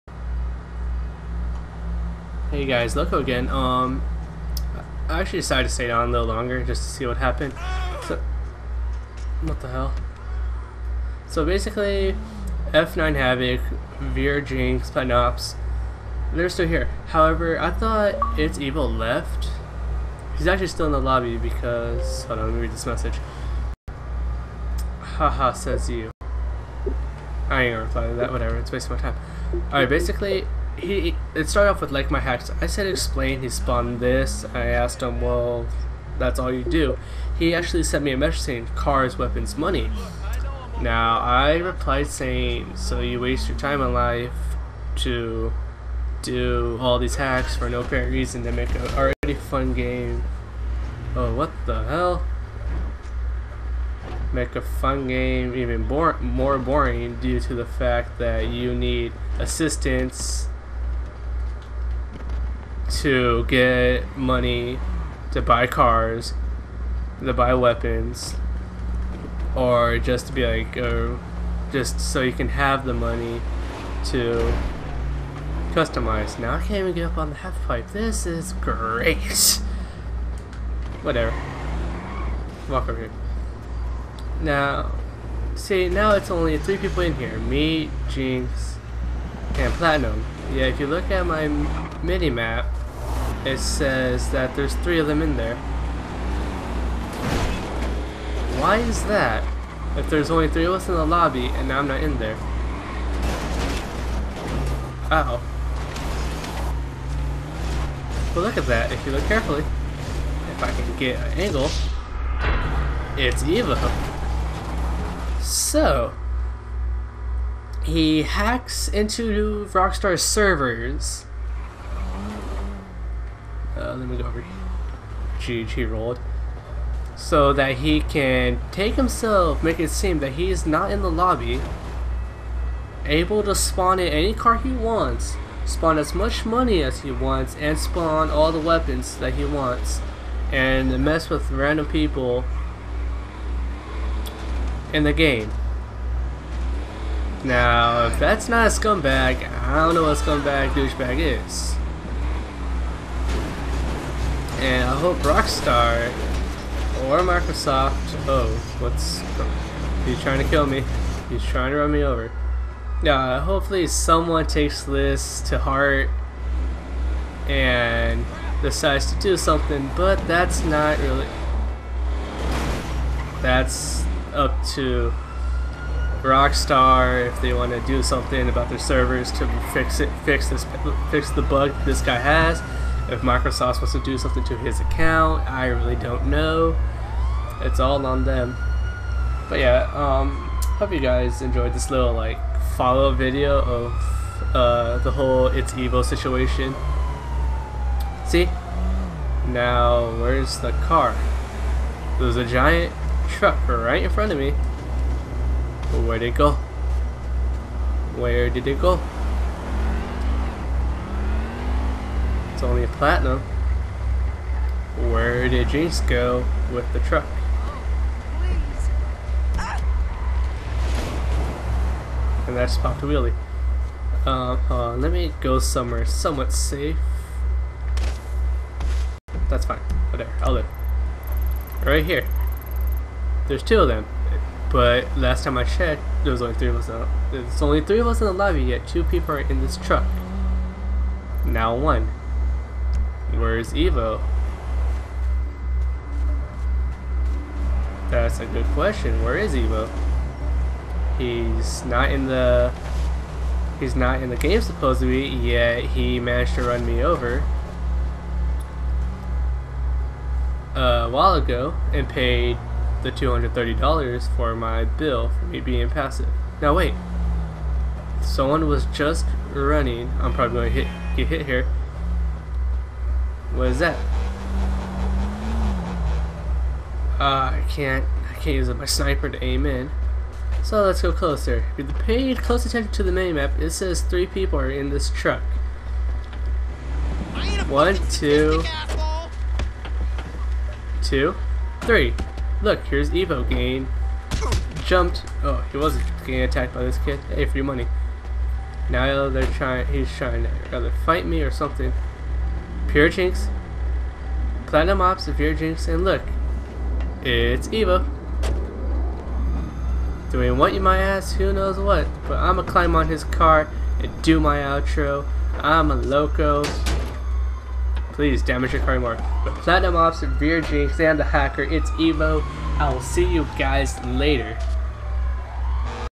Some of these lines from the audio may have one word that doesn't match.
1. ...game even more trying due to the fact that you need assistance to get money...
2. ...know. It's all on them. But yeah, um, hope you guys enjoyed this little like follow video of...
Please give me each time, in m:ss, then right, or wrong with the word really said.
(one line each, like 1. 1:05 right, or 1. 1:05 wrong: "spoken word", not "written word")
1. 0:55 wrong: "boring", not "trying"
2. 3:06 right.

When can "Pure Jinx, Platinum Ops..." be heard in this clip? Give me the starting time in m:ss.
5:02.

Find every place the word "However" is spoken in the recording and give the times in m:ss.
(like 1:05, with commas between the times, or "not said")
0:17.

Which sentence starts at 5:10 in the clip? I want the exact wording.
Doing what you might ask, who knows what, but I'ma climb on his car and do my outro.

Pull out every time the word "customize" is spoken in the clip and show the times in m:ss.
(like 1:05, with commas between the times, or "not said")
1:15.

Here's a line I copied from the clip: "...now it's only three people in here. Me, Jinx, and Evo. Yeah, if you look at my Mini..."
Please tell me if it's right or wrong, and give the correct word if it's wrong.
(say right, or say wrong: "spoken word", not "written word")
wrong: "Platinum", not "Evo".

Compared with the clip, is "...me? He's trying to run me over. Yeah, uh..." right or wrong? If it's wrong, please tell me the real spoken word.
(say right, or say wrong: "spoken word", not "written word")
right.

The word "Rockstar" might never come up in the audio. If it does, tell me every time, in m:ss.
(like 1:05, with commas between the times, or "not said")
1:59, 2:35, 2:56.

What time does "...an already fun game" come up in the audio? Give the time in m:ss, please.
0:48.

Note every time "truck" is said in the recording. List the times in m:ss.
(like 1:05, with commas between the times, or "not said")
3:23, 3:36, 3:59, 4:45.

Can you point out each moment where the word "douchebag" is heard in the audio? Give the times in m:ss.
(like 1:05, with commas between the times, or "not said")
2:30.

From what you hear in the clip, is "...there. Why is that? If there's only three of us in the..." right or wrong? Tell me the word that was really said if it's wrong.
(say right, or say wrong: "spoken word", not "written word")
right.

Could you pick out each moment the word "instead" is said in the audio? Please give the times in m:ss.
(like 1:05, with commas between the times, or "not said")
not said.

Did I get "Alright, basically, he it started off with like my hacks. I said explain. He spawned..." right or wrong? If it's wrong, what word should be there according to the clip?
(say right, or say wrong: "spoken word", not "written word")
right.